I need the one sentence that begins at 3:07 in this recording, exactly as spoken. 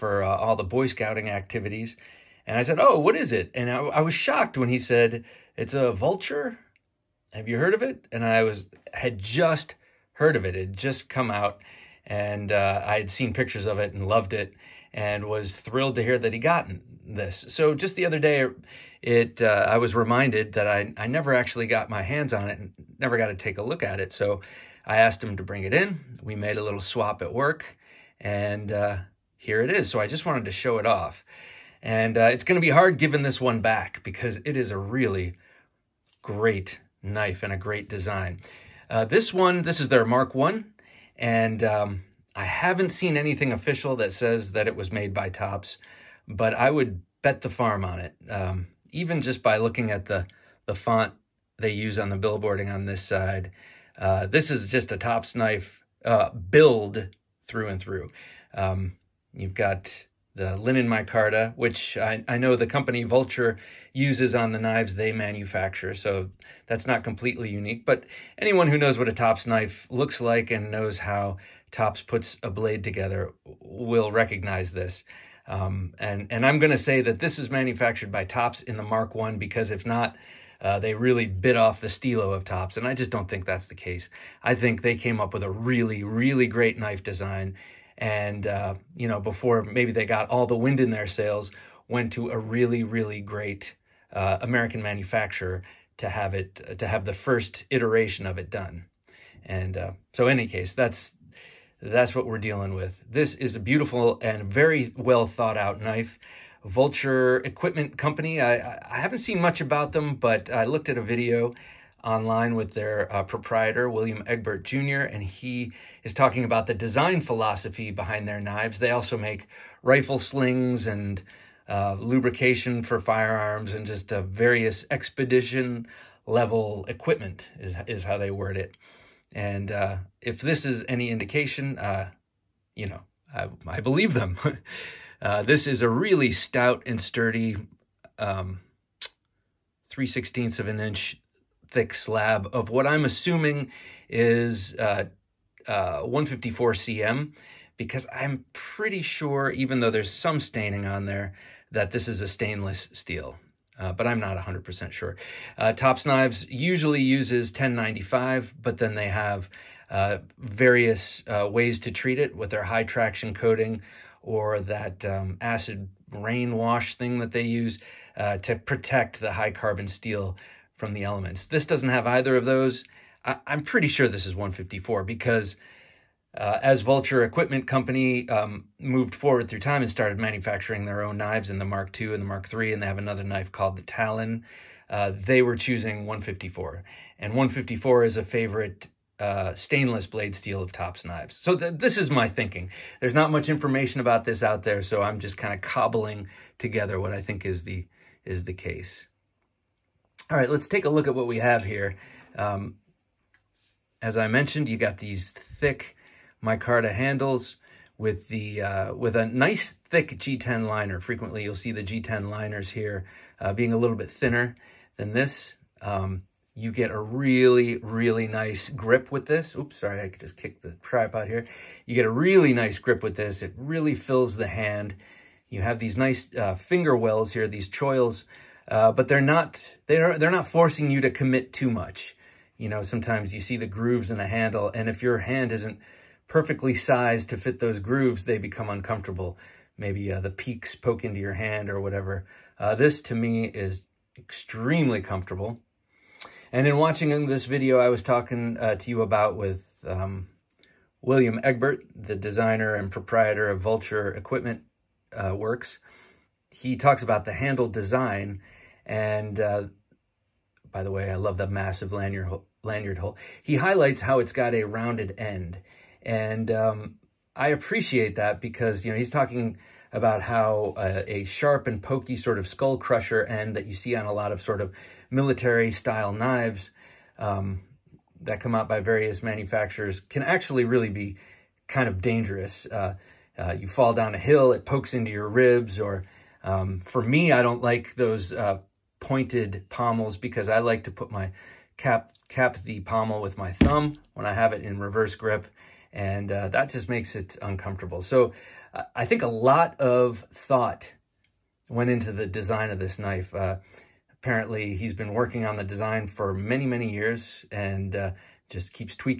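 And 154 is a favorite uh, stainless blade steel of Tops knives.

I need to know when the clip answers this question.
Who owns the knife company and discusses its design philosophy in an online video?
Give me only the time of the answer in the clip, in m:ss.
1:53.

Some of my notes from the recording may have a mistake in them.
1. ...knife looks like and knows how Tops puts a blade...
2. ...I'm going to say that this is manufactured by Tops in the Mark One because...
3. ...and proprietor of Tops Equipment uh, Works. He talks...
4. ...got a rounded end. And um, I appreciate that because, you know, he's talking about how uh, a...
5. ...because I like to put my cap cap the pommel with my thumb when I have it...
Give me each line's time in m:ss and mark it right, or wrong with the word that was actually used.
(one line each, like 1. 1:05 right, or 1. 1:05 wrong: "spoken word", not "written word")
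1. 1:09 right
2. 1:16 right
3. 4:12 wrong: "Vulture", not "Tops"
4. 4:24 right
5. 4:50 right.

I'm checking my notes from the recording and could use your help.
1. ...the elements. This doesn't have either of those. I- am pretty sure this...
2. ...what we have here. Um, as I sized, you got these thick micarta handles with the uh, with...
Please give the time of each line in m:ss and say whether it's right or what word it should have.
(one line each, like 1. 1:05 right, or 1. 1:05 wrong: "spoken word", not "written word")
1. 2:50 right
2. 3:21 wrong: "mentioned", not "sized".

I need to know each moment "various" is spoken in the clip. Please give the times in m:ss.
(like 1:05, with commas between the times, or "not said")
2:04, 2:40, 4:38.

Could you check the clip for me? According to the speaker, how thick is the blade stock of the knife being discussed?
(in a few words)
3/16 of an inch.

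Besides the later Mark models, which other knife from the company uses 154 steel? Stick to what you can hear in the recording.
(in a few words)
Talon.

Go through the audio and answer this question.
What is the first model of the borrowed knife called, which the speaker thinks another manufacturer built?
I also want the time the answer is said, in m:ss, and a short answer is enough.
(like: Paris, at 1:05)
Mark 1, at 0:40.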